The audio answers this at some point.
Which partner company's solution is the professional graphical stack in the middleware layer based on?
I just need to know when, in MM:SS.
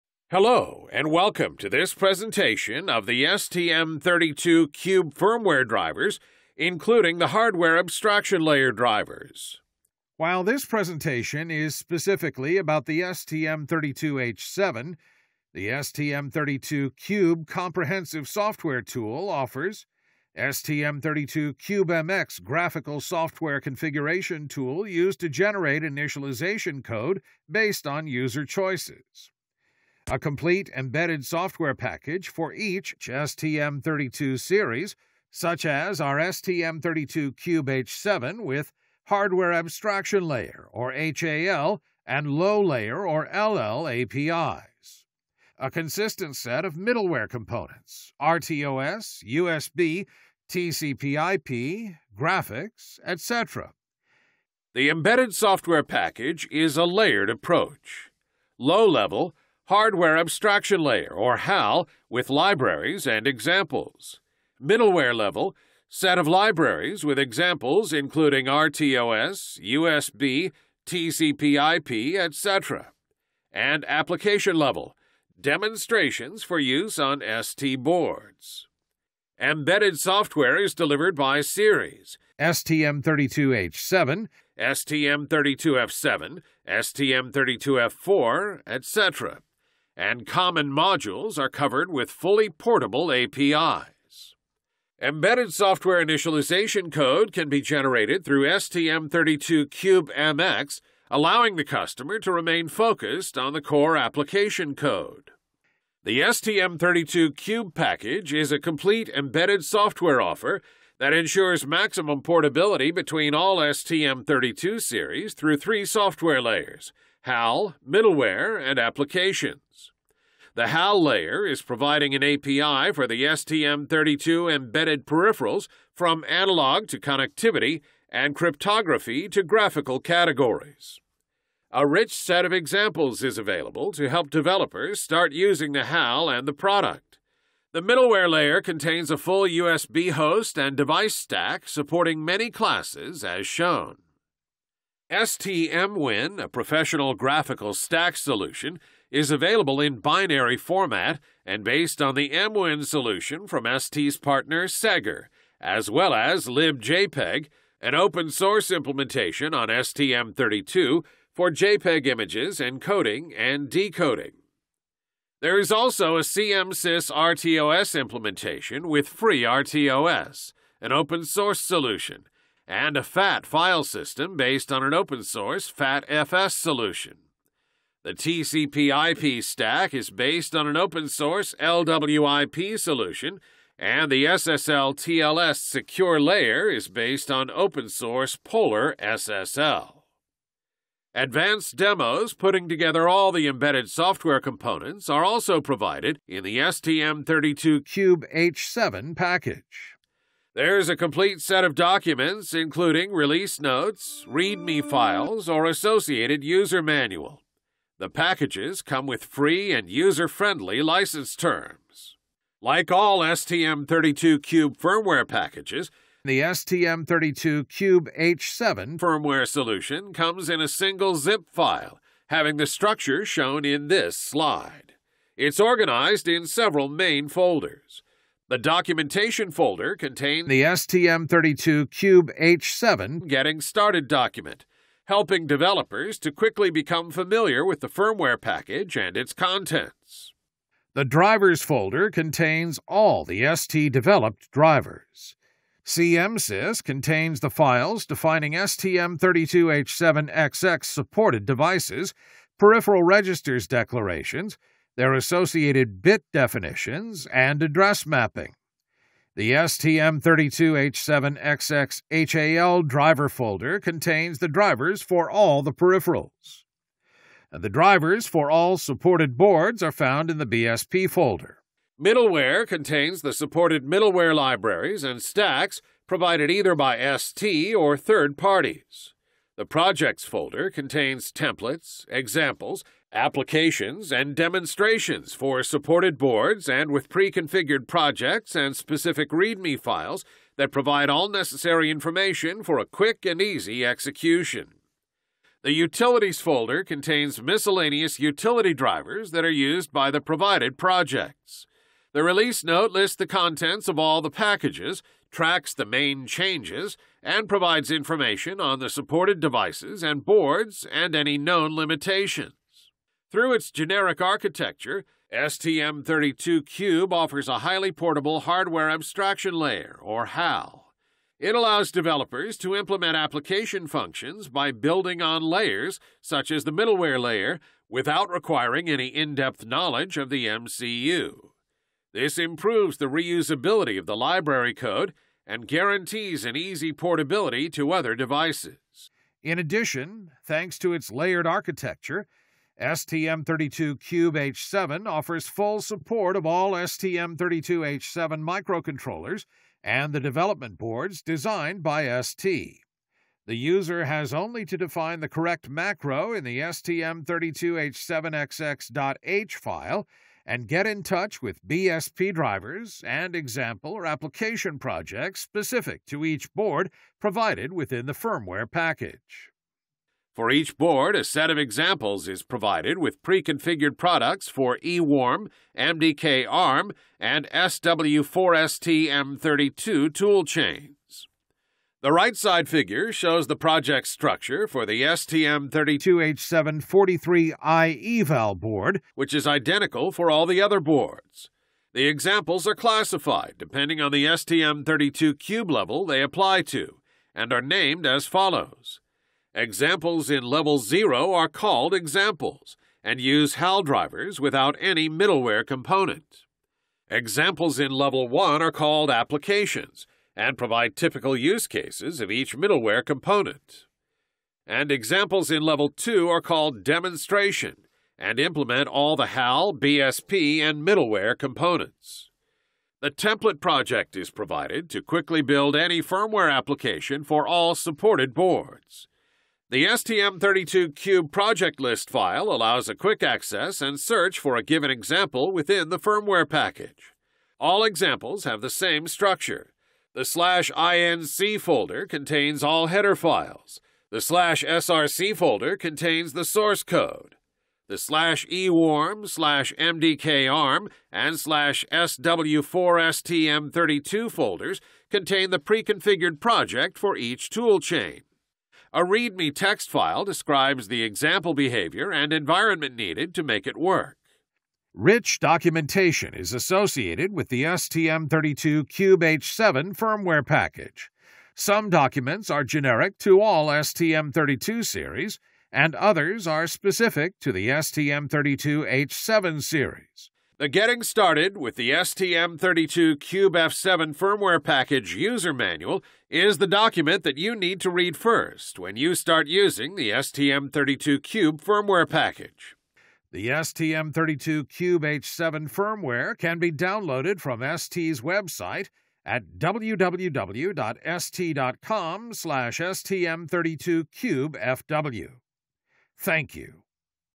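02:34.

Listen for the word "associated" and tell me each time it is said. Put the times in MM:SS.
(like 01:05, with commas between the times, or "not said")
03:25, 04:15, 07:46.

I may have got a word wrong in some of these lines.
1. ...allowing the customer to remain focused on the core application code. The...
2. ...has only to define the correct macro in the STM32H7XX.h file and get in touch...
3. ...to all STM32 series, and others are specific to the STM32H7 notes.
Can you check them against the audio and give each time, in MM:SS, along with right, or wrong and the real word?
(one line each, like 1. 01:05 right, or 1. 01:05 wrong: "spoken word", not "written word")
1. 01:41 right
2. 05:54 right
3. 07:53 wrong: "series", not "notes".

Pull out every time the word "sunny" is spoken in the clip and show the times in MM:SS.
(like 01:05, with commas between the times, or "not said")
not said.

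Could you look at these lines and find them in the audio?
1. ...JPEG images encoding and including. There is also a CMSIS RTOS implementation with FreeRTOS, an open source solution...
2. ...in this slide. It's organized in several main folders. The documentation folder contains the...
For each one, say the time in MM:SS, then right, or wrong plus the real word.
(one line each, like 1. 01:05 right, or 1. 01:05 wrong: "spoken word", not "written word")
1. 02:41 wrong: "decoding", not "including"
2. 03:43 right.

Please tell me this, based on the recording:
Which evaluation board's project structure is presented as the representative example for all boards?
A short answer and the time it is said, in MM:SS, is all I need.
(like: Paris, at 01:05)
STM32H743i eval board, at 06:25.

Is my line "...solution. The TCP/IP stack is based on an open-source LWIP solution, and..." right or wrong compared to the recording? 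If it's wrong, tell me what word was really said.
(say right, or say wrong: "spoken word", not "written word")
right.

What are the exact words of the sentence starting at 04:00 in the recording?
The drivers folder contains all the ST developed drivers.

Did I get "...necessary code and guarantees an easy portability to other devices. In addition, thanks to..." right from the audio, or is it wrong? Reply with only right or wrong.
wrong.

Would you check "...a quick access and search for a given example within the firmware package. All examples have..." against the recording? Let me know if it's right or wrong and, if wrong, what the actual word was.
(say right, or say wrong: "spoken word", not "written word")
right.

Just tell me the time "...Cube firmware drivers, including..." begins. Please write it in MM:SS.
00:04.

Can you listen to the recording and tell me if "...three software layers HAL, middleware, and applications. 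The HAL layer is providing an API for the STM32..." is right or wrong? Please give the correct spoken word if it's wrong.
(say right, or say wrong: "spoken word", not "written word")
right.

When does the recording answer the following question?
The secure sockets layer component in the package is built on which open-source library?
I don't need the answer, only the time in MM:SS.
03:08.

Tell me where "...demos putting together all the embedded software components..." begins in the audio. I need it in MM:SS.
03:11.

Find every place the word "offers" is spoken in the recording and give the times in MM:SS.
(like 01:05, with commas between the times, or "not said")
00:19, 01:50, 05:17, 05:45.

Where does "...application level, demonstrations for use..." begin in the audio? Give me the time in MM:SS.
01:13.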